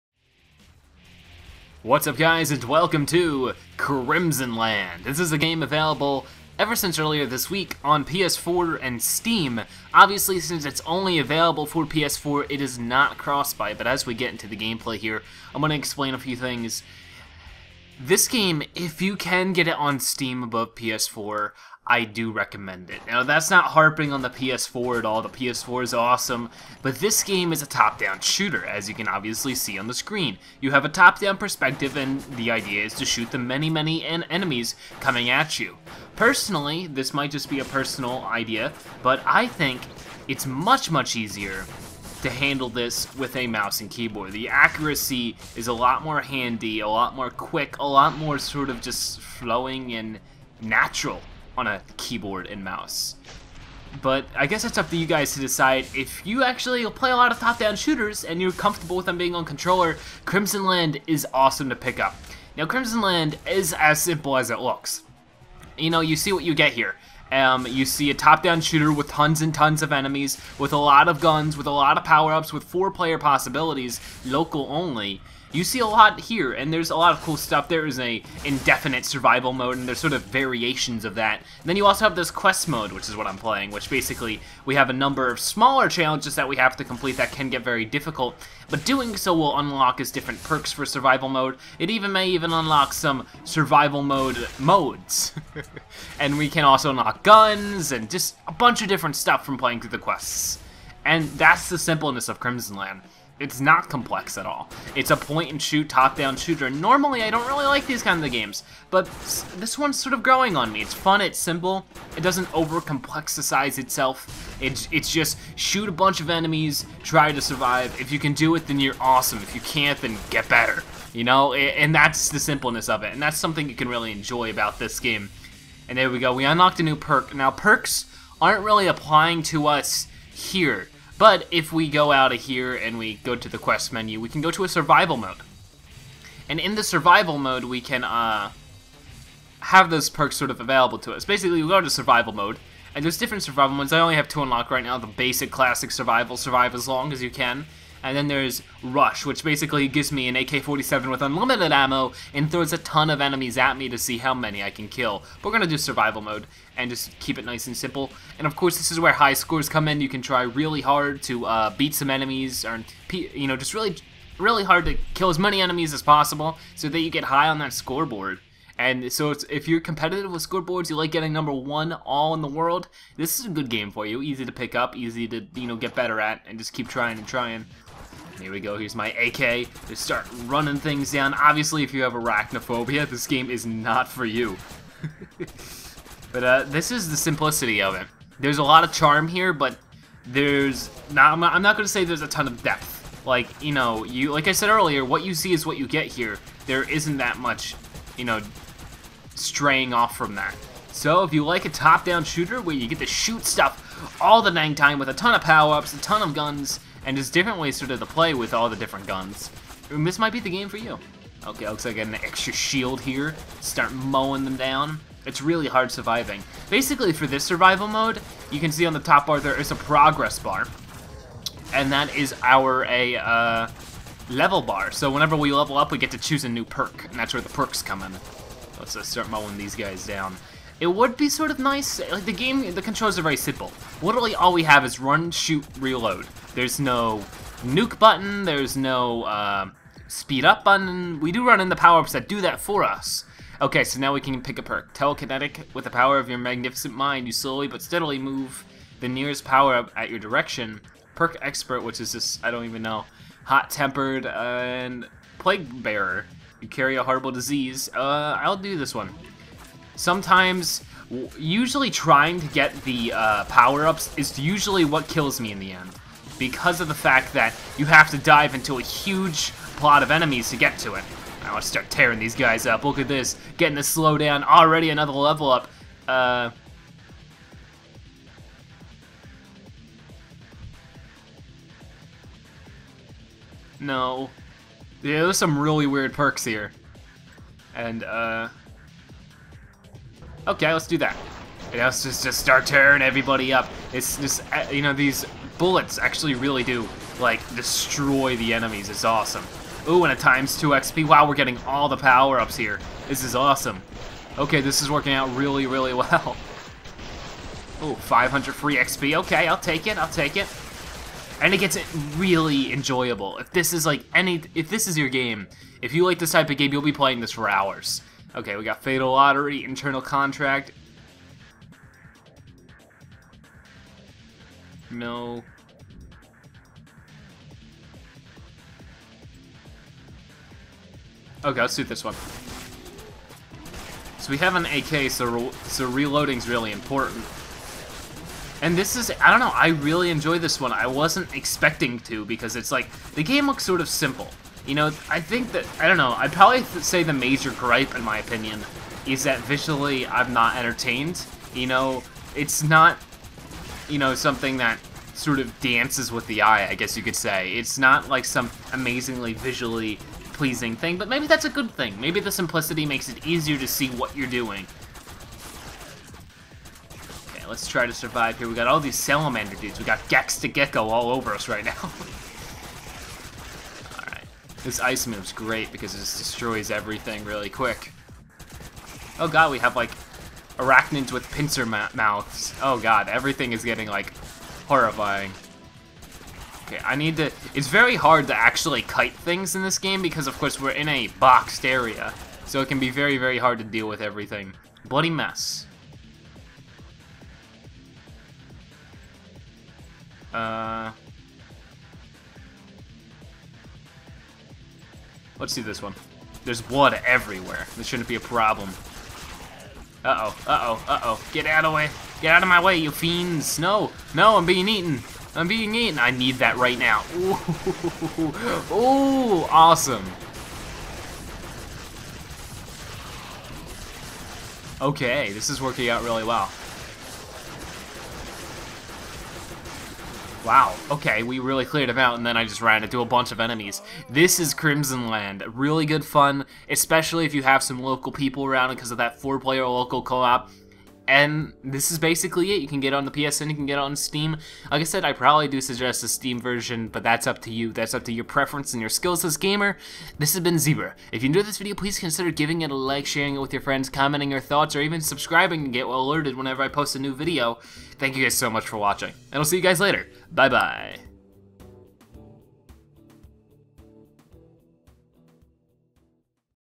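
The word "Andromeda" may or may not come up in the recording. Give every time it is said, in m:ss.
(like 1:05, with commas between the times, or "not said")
not said.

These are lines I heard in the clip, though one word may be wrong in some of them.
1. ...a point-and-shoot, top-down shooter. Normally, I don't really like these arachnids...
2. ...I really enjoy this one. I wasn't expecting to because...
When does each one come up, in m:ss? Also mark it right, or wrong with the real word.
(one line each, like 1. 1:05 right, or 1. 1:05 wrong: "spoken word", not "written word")
1. 1:45 wrong: "kinds", not "arachnids"
2. 5:39 right.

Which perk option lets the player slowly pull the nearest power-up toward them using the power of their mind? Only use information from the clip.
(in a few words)
Telekinetic.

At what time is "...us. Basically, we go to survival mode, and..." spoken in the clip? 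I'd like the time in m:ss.
2:21.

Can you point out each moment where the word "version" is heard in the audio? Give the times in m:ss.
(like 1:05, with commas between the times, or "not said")
7:26.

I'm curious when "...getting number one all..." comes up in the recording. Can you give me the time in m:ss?
2:51.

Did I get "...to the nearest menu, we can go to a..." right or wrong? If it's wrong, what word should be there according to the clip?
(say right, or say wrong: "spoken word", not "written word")
wrong: "quest", not "nearest".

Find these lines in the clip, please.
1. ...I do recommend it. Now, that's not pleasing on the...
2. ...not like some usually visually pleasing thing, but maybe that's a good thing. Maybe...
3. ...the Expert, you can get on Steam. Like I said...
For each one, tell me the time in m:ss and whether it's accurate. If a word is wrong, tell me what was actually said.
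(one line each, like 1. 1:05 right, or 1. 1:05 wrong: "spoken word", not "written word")
1. 0:21 wrong: "harping", not "pleasing"
2. 5:57 wrong: "amazingly", not "usually"
3. 7:23 wrong: "PSN", not "Expert".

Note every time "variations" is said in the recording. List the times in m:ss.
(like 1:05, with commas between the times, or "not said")
1:20.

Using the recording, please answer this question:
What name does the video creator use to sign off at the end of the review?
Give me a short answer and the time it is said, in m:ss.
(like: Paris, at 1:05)
Zebra, at 7:30.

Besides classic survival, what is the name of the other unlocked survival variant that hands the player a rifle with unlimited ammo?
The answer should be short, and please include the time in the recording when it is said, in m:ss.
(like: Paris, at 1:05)
Rush, at 2:28.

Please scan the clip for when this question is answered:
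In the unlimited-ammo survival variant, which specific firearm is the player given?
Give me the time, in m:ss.
2:30.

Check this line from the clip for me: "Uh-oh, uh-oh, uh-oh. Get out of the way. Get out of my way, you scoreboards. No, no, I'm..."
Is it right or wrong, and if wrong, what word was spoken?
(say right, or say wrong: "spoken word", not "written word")
wrong: "fiends", not "scoreboards".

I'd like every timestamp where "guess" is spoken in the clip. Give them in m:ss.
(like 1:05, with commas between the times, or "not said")
0:54, 5:56.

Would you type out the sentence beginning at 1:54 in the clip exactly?
It's, it's just shoot a bunch of enemies, try to survive.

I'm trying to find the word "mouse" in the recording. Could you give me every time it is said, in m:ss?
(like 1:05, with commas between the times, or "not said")
0:43, 0:52.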